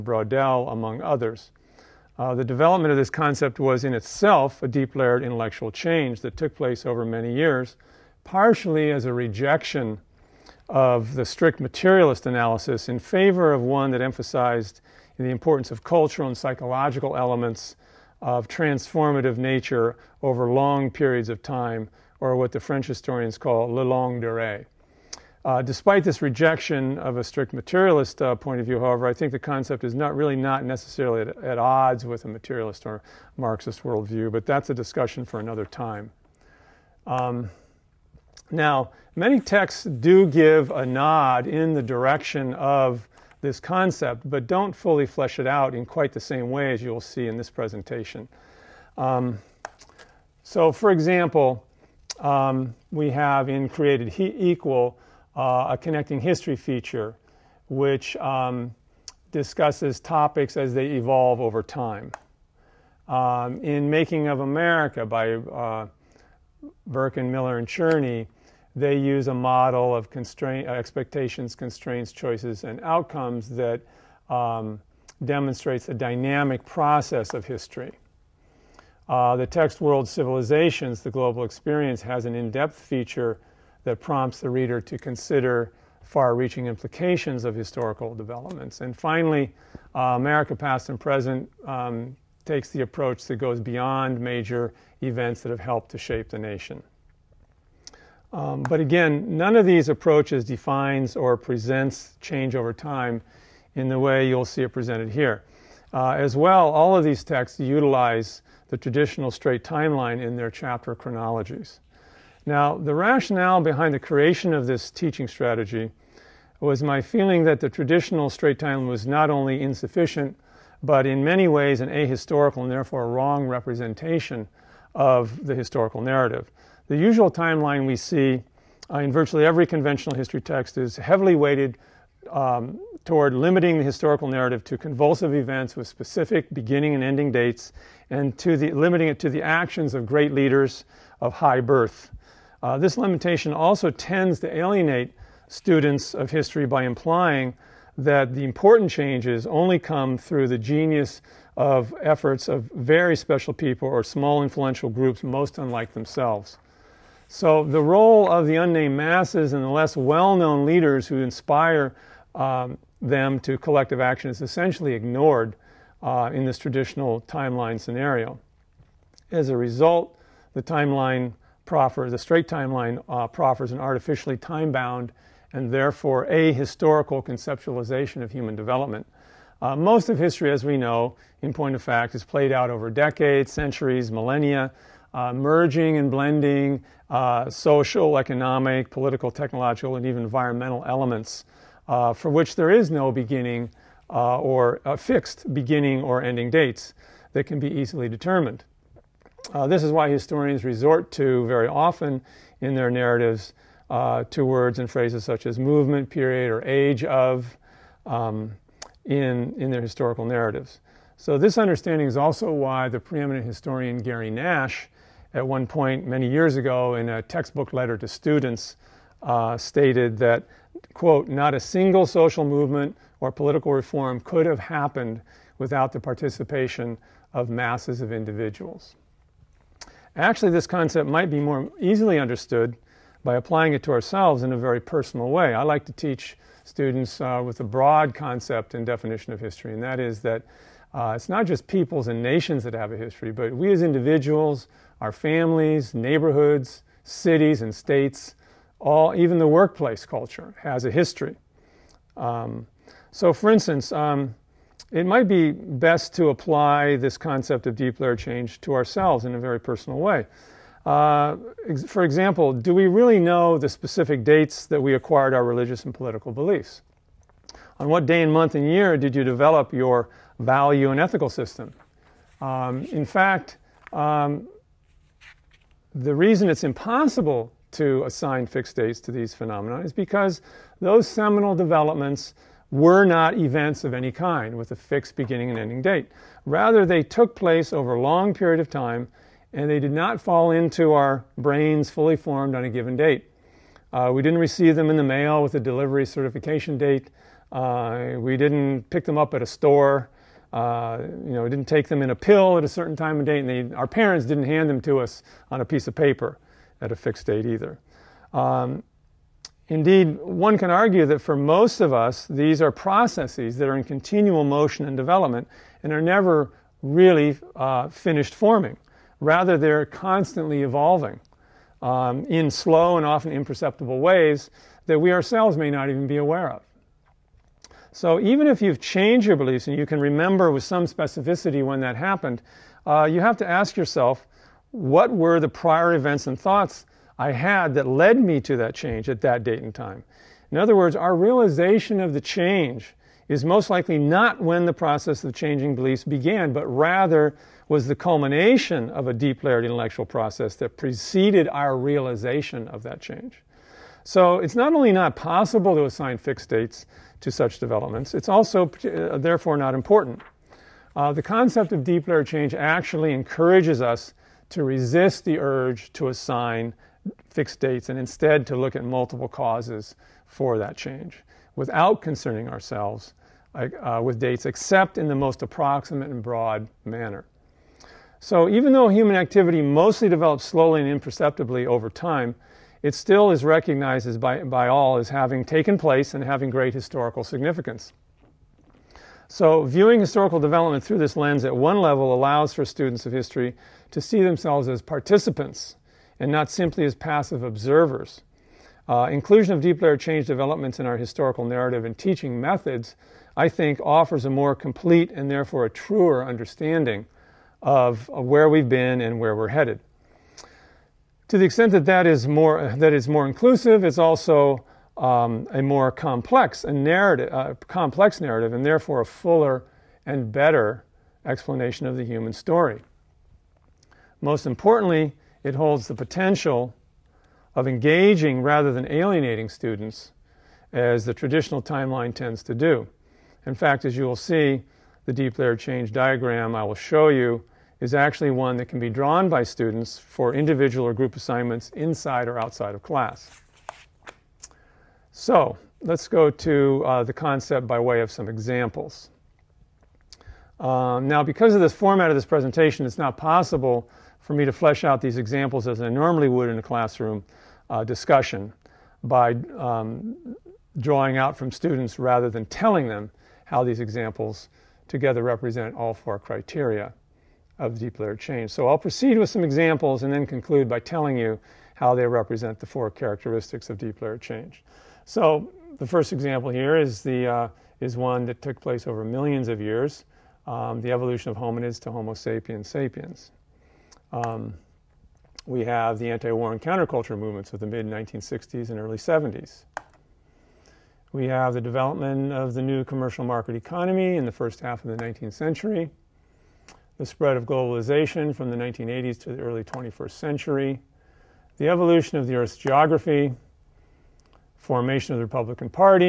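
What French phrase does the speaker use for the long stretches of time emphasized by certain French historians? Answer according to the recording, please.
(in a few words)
le longue durée.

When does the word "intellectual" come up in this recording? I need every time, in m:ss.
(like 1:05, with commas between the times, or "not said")
0:05, 5:49.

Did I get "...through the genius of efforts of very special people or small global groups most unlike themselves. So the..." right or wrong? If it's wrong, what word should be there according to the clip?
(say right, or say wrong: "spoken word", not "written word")
wrong: "influential", not "global".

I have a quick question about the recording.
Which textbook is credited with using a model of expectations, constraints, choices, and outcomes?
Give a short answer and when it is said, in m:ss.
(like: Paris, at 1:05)
Making of America, at 1:03.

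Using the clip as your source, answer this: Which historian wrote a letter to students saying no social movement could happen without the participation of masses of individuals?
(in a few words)
Gary Nash.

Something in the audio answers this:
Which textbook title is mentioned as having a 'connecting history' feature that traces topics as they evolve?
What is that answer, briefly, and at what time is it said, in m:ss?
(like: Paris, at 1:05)
Created Equal, at 0:53.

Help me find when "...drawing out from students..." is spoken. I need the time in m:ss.
7:40.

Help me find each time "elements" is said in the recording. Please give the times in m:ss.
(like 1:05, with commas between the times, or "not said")
0:17, 3:10.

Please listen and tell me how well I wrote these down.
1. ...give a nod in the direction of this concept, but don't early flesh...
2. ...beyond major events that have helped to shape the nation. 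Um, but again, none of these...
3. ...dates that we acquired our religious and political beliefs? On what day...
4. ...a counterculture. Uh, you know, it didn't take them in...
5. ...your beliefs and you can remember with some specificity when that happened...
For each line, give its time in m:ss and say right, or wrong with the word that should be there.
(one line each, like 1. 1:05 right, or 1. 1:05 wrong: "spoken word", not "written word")
1. 0:40 wrong: "fully", not "early"
2. 1:33 right
3. 4:24 right
4. 4:59 wrong: "store", not "counterculture"
5. 5:29 right.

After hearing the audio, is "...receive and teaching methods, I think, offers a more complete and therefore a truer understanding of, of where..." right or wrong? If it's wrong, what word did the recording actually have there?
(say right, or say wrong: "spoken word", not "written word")
wrong: "narrative", not "receive".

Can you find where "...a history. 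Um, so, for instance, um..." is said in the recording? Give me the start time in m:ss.
4:10.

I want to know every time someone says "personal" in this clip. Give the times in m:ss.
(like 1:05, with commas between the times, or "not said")
3:54, 4:19.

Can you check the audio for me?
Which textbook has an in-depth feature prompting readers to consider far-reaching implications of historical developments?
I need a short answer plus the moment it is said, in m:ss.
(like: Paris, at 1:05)
World Civilizations, at 1:19.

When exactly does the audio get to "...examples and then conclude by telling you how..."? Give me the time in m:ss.
7:49.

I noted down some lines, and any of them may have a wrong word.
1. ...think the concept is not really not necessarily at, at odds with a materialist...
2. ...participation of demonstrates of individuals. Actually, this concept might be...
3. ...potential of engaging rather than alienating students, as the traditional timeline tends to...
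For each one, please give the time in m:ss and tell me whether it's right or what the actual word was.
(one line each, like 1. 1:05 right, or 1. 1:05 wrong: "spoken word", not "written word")
1. 0:29 right
2. 3:45 wrong: "masses", not "demonstrates"
3. 7:05 right.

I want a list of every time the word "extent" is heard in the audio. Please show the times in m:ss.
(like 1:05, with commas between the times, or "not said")
6:51.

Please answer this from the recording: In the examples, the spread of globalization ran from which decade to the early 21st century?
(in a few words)
1980s.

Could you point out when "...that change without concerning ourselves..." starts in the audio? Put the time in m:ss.
6:10.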